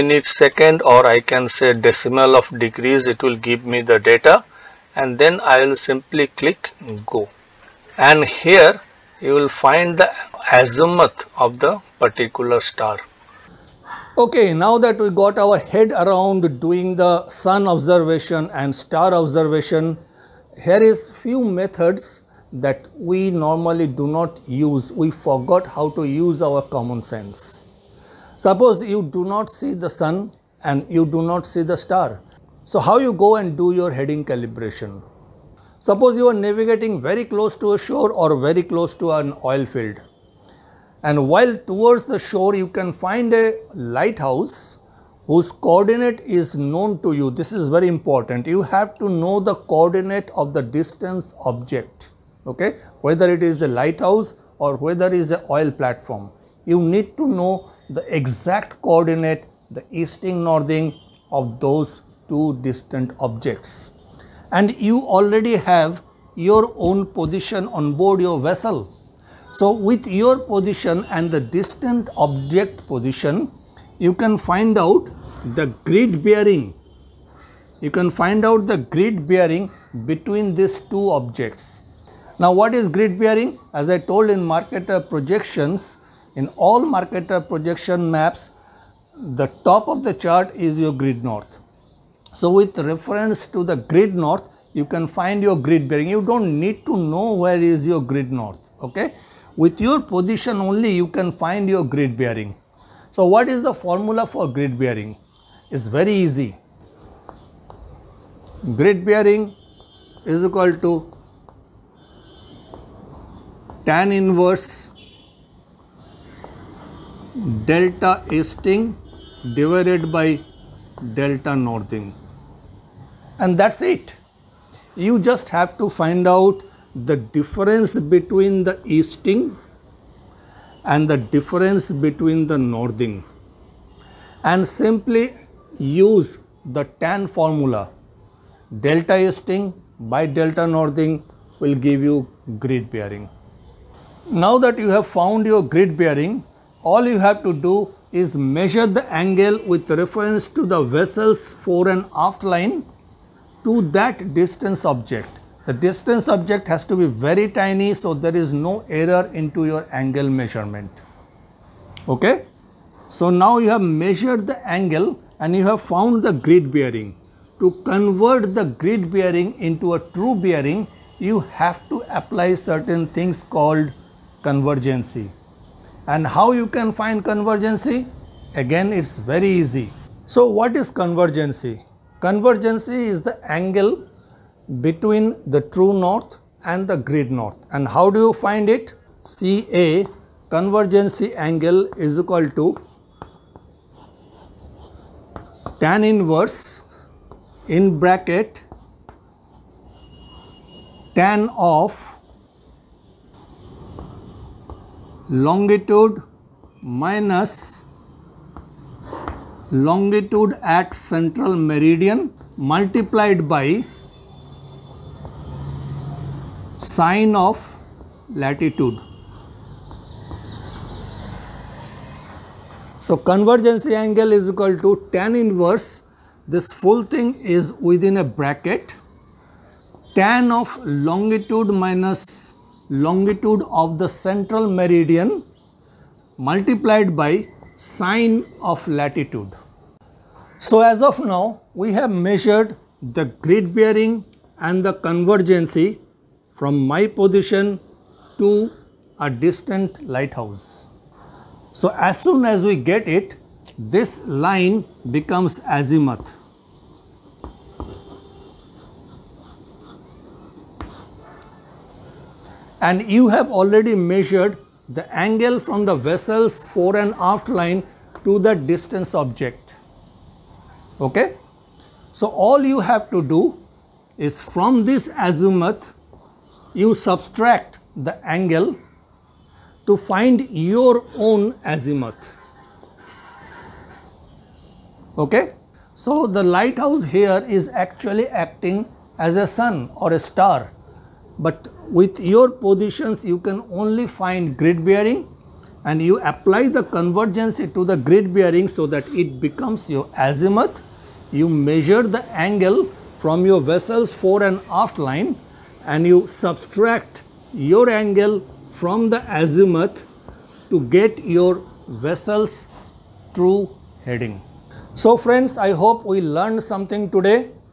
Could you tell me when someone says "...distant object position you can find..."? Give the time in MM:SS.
01:11.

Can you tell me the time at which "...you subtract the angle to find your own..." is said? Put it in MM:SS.
04:36.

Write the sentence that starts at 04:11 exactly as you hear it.
So as soon as we get it, this line becomes azimuth.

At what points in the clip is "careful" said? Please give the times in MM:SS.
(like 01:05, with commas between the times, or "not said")
not said.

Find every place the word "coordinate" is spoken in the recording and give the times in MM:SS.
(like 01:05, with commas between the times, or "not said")
00:45, 00:49, 00:58.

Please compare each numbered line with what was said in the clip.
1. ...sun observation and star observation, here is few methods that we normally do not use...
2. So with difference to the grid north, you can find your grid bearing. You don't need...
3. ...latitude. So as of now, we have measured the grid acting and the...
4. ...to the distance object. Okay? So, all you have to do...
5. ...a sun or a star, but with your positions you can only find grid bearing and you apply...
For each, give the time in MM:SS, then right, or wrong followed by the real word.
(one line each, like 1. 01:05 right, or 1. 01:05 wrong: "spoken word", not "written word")
1. 00:17 right
2. 01:32 wrong: "reference", not "difference"
3. 03:58 wrong: "bearing", not "acting"
4. 04:28 right
5. 04:49 right.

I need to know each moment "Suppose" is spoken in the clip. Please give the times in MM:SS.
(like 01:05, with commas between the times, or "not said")
00:28, 00:35.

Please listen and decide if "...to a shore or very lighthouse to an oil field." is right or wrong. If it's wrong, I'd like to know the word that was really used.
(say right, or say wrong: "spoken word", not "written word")
wrong: "close", not "lighthouse".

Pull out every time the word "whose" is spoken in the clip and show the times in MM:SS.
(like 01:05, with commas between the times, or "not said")
00:45.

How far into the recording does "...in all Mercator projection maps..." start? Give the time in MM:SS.
01:26.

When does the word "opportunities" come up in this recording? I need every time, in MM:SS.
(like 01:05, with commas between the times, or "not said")
not said.